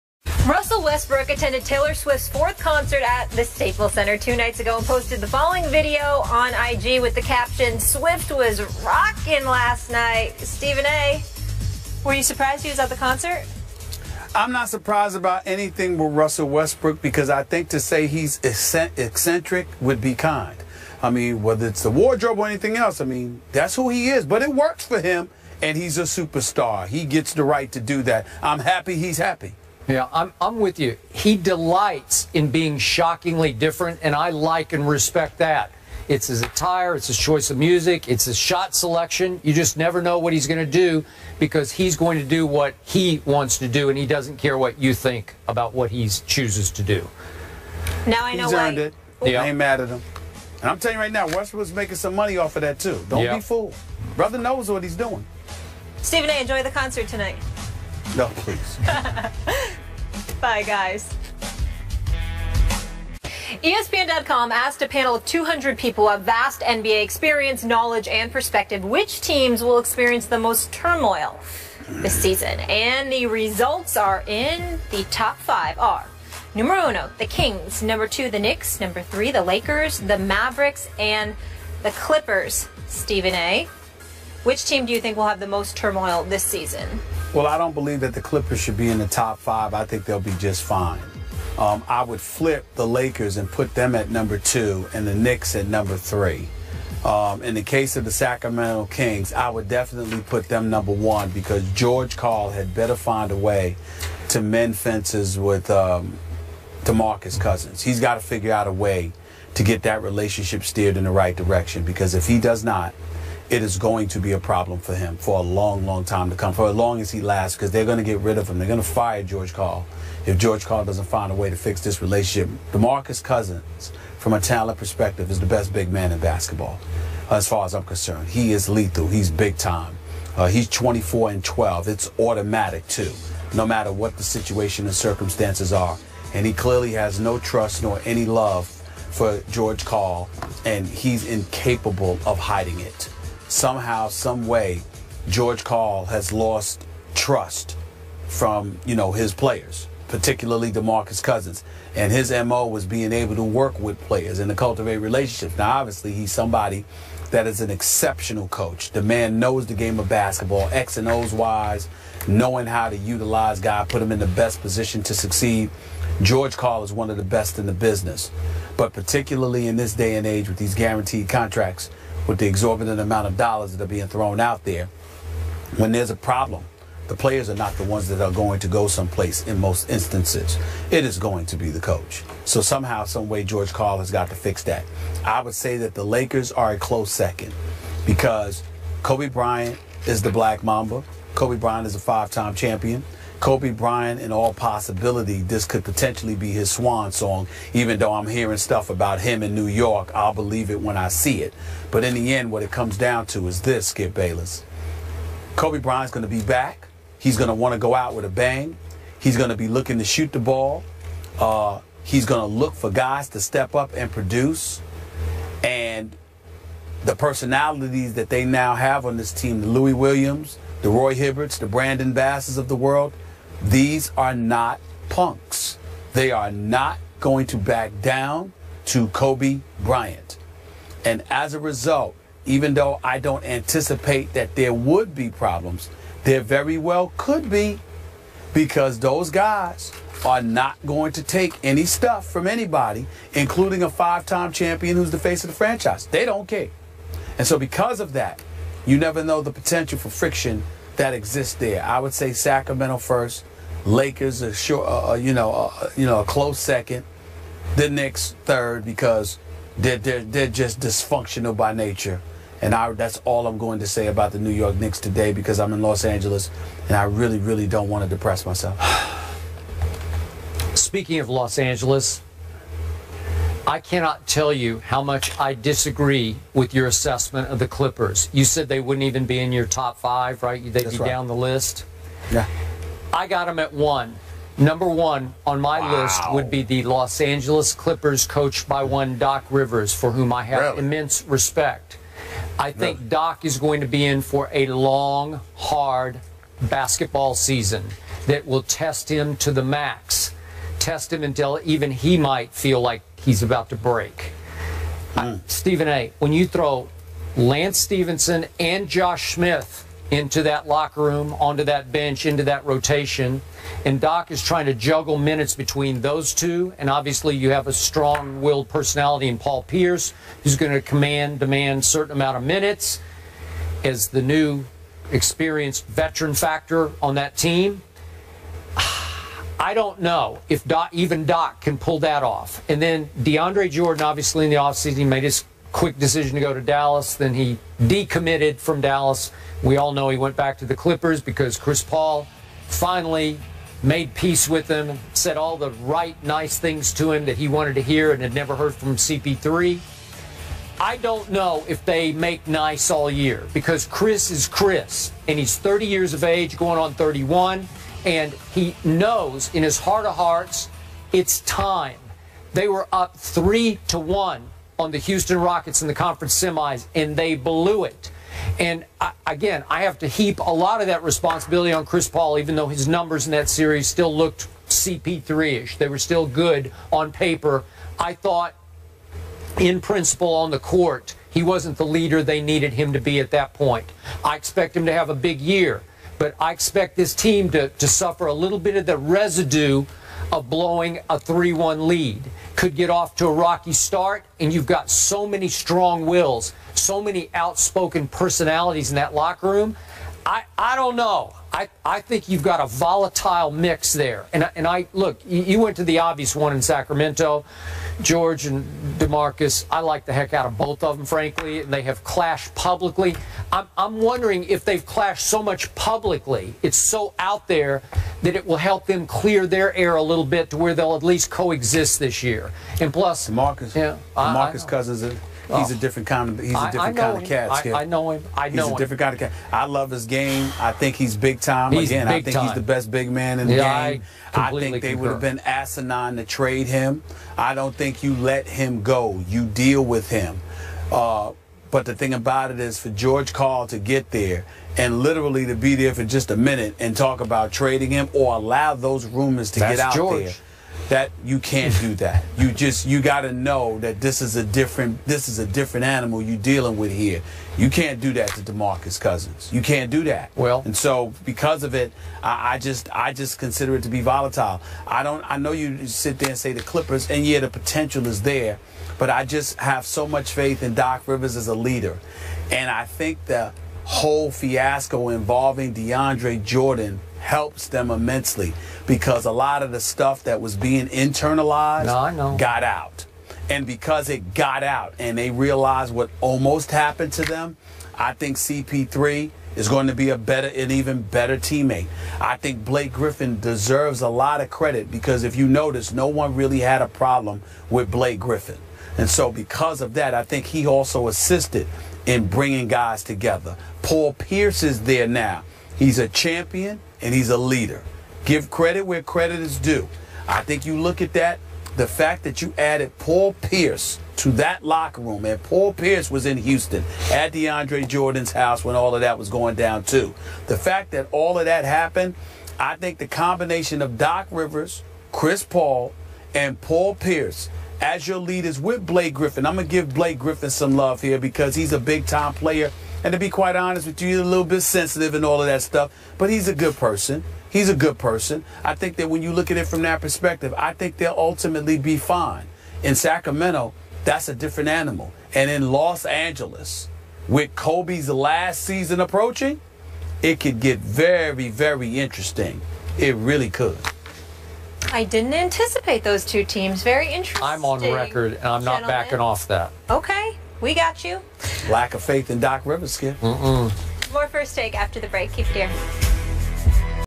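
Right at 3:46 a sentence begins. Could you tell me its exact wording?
They are not going to back down to Kobe Bryant.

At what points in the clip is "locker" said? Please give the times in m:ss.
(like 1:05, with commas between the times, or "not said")
5:10, 6:39, 8:34.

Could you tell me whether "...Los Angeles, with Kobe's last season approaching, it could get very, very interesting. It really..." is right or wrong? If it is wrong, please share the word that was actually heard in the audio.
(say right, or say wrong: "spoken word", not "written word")
right.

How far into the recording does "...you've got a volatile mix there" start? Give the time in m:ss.
6:42.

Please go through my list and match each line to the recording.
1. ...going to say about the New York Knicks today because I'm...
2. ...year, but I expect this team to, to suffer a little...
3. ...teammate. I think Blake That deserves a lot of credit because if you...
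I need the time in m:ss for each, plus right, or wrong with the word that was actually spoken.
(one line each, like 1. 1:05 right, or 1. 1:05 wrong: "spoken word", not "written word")
1. 4:23 right
2. 6:25 right
3. 8:11 wrong: "Griffin", not "That".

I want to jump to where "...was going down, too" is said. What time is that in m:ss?
8:39.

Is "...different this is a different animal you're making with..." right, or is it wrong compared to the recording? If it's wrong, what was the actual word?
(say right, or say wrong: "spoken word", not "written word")
wrong: "dealing", not "making".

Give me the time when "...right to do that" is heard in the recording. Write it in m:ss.
0:27.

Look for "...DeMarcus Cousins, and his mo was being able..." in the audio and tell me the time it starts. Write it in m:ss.
2:30.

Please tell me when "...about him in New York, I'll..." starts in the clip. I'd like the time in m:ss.
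3:18.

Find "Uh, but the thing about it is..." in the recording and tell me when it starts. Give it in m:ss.
7:20.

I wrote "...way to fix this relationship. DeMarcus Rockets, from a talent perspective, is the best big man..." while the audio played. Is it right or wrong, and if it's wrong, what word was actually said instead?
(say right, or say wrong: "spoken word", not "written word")
wrong: "Cousins", not "Rockets".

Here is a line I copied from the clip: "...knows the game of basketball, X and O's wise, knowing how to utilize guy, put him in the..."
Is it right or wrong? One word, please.
right.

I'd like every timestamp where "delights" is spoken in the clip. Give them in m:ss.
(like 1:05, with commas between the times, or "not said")
0:31.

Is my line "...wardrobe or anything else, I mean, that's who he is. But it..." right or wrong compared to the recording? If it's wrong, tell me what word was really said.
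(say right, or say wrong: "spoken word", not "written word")
right.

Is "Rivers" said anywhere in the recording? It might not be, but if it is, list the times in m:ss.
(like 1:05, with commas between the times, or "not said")
4:49, 7:51, 8:44, 9:22.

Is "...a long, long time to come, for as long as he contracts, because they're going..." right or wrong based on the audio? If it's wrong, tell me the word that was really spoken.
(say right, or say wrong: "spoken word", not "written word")
wrong: "lasts", not "contracts".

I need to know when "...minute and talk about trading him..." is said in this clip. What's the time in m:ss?
7:26.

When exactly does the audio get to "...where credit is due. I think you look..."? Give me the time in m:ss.
8:28.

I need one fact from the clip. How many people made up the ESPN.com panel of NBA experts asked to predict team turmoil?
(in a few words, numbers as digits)
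200.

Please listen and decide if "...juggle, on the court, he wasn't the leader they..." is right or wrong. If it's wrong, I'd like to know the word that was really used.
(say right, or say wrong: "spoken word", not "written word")
wrong: "principle", not "juggle".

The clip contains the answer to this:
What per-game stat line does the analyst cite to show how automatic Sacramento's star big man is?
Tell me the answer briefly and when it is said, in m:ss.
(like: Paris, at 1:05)
24 and 12, at 2:10.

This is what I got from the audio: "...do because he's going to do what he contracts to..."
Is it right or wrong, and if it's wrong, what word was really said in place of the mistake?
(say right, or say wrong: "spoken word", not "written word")
wrong: "wants", not "contracts".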